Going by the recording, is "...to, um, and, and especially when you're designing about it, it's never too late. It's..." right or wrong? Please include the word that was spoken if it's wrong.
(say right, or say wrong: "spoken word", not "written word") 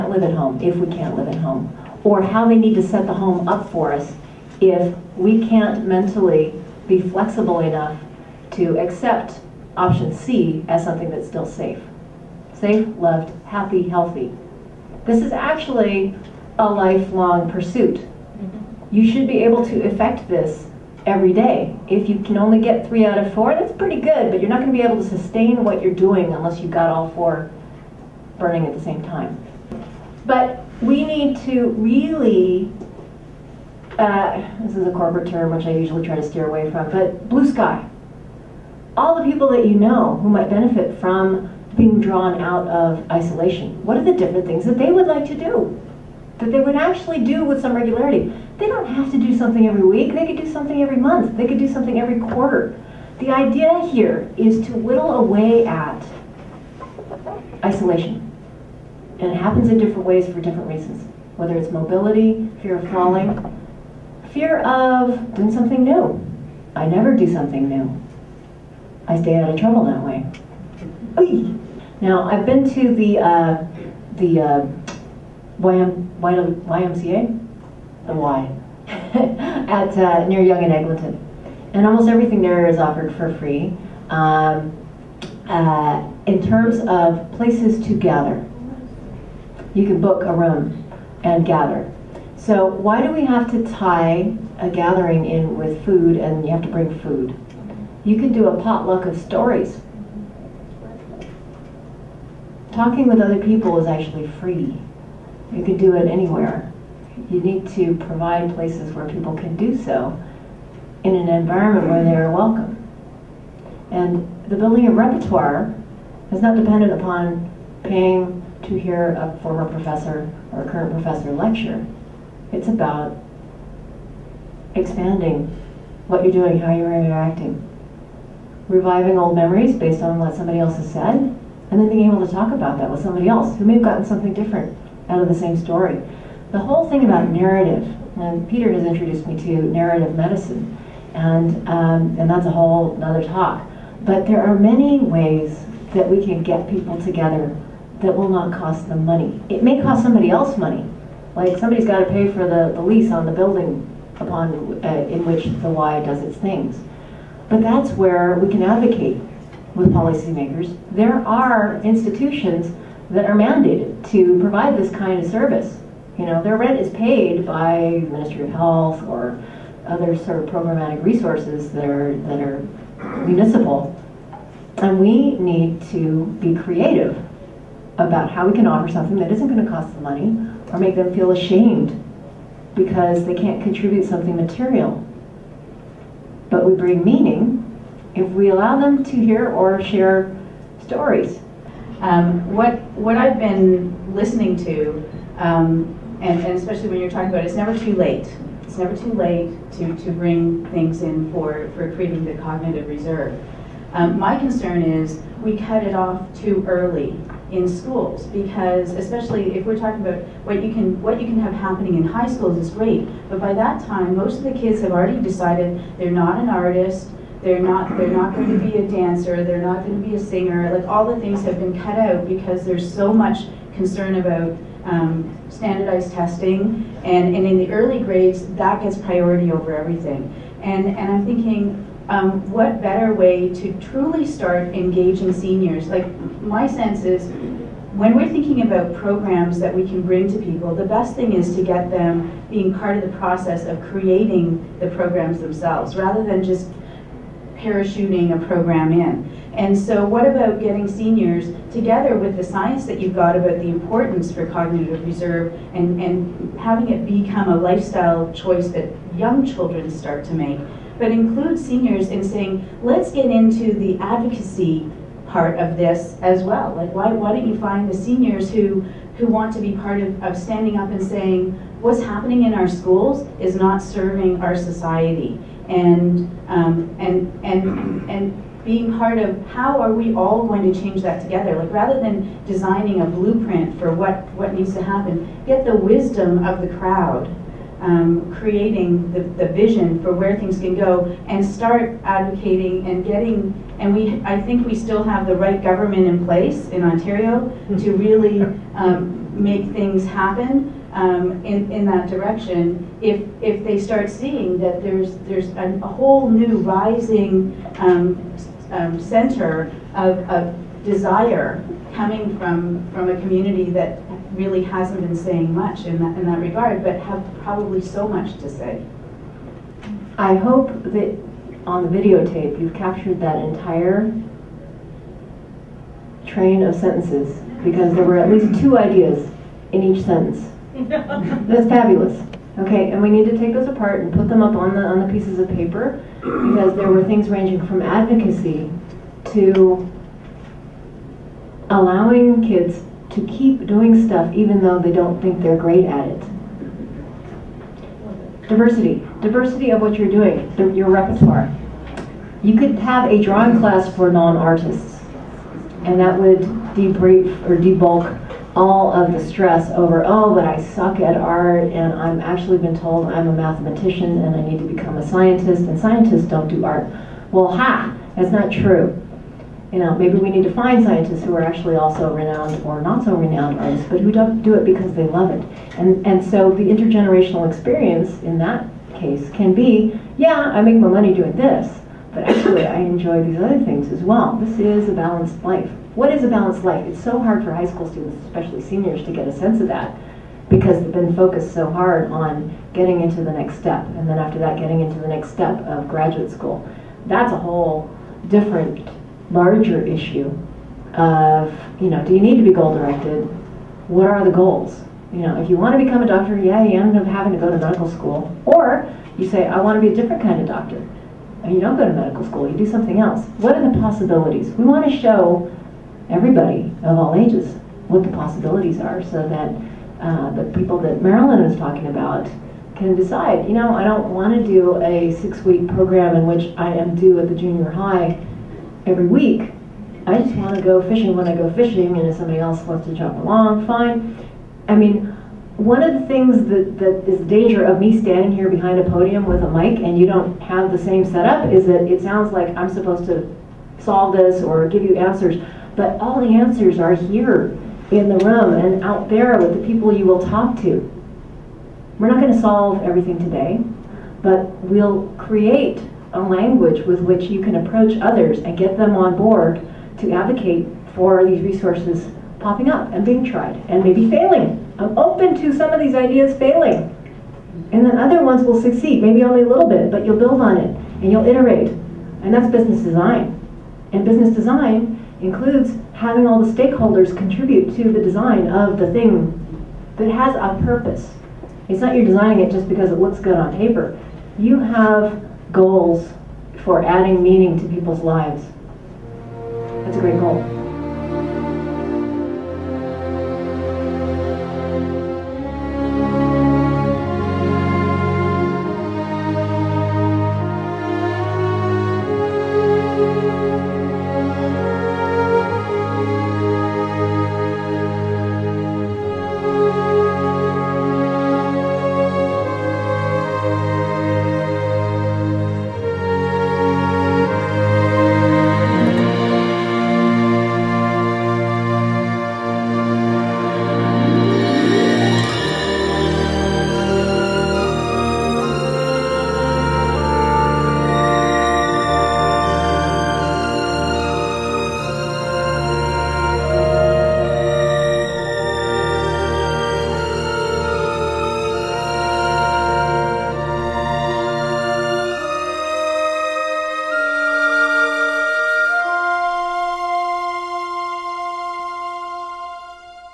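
wrong: "talking", not "designing".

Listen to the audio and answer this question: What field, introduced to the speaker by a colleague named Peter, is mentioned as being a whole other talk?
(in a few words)
narrative medicine.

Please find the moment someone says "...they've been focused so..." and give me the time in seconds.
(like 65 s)
390 s.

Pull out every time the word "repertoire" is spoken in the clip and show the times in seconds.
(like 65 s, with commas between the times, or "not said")
114 s, 350 s.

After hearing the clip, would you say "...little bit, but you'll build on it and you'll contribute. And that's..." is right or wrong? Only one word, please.
wrong.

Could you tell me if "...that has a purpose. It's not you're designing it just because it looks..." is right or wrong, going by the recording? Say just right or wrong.
right.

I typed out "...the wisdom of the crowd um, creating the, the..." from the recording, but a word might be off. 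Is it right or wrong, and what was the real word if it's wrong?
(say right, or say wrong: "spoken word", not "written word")
right.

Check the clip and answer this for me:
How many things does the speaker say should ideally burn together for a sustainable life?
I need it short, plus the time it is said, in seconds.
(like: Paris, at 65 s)
4, at 26 s.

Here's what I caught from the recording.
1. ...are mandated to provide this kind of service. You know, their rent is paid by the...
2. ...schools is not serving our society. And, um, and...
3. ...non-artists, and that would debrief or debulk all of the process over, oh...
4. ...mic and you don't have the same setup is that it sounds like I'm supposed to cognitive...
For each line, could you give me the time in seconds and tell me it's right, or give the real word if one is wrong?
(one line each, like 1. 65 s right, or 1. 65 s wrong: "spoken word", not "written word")
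1. 163 s right
2. 272 s right
3. 354 s wrong: "stress", not "process"
4. 439 s wrong: "solve", not "cognitive".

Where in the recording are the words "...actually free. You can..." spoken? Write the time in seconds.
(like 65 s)
103 s.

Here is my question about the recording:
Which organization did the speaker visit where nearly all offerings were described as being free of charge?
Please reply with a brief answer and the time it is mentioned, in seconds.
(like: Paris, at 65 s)
YMCA, at 76 s.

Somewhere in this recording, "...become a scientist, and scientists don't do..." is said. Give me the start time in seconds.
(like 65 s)
364 s.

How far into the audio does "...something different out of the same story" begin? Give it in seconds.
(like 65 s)
134 s.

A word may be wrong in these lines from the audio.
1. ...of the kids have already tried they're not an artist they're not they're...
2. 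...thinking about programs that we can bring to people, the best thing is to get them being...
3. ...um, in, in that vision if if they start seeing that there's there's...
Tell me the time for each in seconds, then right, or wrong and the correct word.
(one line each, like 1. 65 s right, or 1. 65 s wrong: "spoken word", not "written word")
1. 214 s wrong: "decided", not "tried"
2. 238 s right
3. 300 s wrong: "direction", not "vision".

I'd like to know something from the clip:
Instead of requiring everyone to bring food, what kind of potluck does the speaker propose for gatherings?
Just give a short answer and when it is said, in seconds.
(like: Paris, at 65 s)
a potluck of stories, at 98 s.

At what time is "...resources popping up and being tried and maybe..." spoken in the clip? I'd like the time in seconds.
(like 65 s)
461 s.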